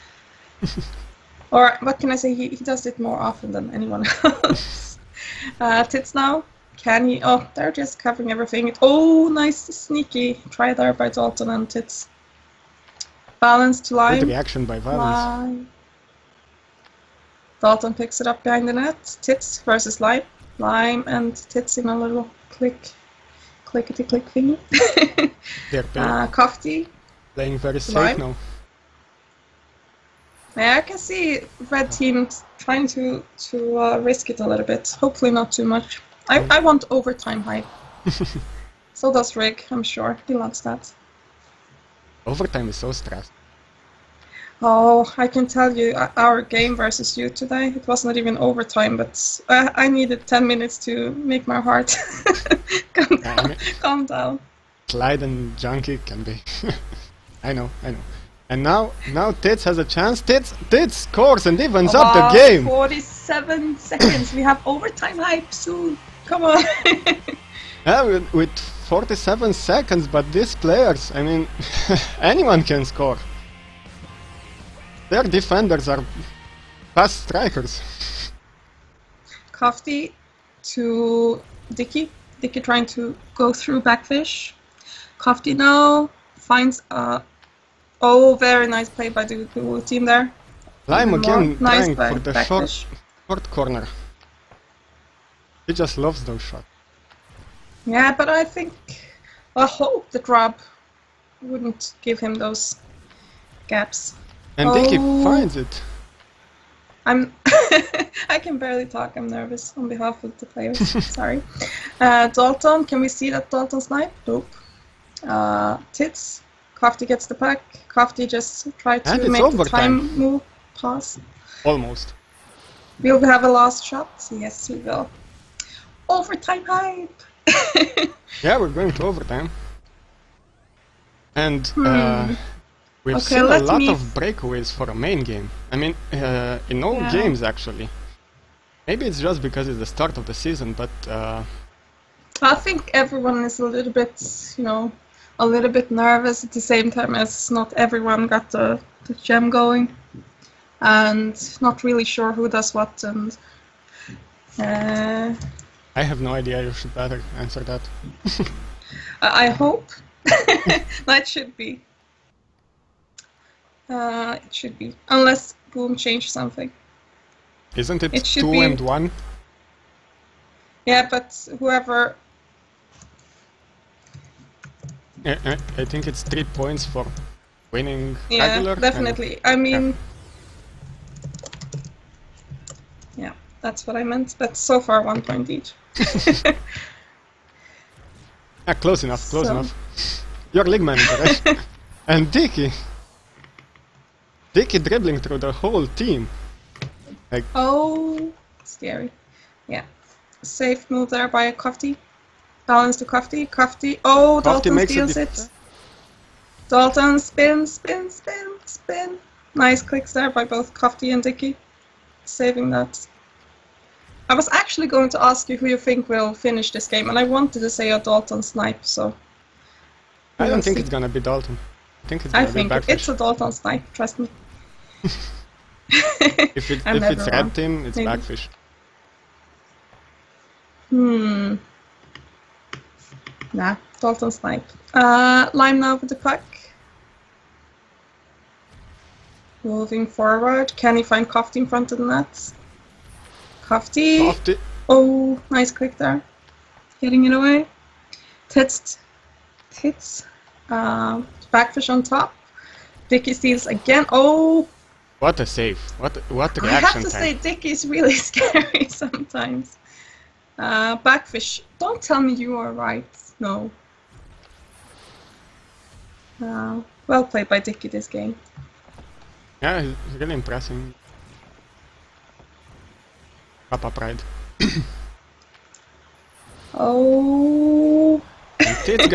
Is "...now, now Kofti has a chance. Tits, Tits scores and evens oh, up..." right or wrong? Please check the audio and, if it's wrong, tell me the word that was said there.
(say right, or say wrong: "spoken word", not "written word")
wrong: "Tits", not "Kofti".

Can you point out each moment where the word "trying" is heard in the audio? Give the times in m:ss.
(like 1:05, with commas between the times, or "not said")
0:32, 1:22, 1:31.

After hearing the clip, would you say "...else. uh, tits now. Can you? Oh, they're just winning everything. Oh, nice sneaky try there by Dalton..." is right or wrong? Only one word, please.
wrong.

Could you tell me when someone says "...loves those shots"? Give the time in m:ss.
1:35.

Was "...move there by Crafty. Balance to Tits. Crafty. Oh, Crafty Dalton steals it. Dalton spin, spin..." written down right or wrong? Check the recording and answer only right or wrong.
wrong.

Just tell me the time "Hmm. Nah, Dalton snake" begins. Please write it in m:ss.
3:50.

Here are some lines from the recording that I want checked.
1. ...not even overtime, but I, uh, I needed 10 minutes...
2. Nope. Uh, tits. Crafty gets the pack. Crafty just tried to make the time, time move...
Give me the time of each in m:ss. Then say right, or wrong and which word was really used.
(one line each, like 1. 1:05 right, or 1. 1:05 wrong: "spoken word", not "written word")
1. 0:48 right
2. 1:54 right.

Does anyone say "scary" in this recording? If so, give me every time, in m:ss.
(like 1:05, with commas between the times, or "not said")
3:18, 4:18.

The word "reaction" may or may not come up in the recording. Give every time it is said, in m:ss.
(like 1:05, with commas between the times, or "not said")
0:14, 4:16.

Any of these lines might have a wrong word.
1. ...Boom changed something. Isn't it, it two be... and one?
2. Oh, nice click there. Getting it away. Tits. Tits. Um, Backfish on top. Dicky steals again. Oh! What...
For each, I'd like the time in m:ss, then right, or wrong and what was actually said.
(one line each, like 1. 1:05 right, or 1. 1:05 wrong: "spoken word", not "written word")
1. 2:45 right
2. 4:04 right.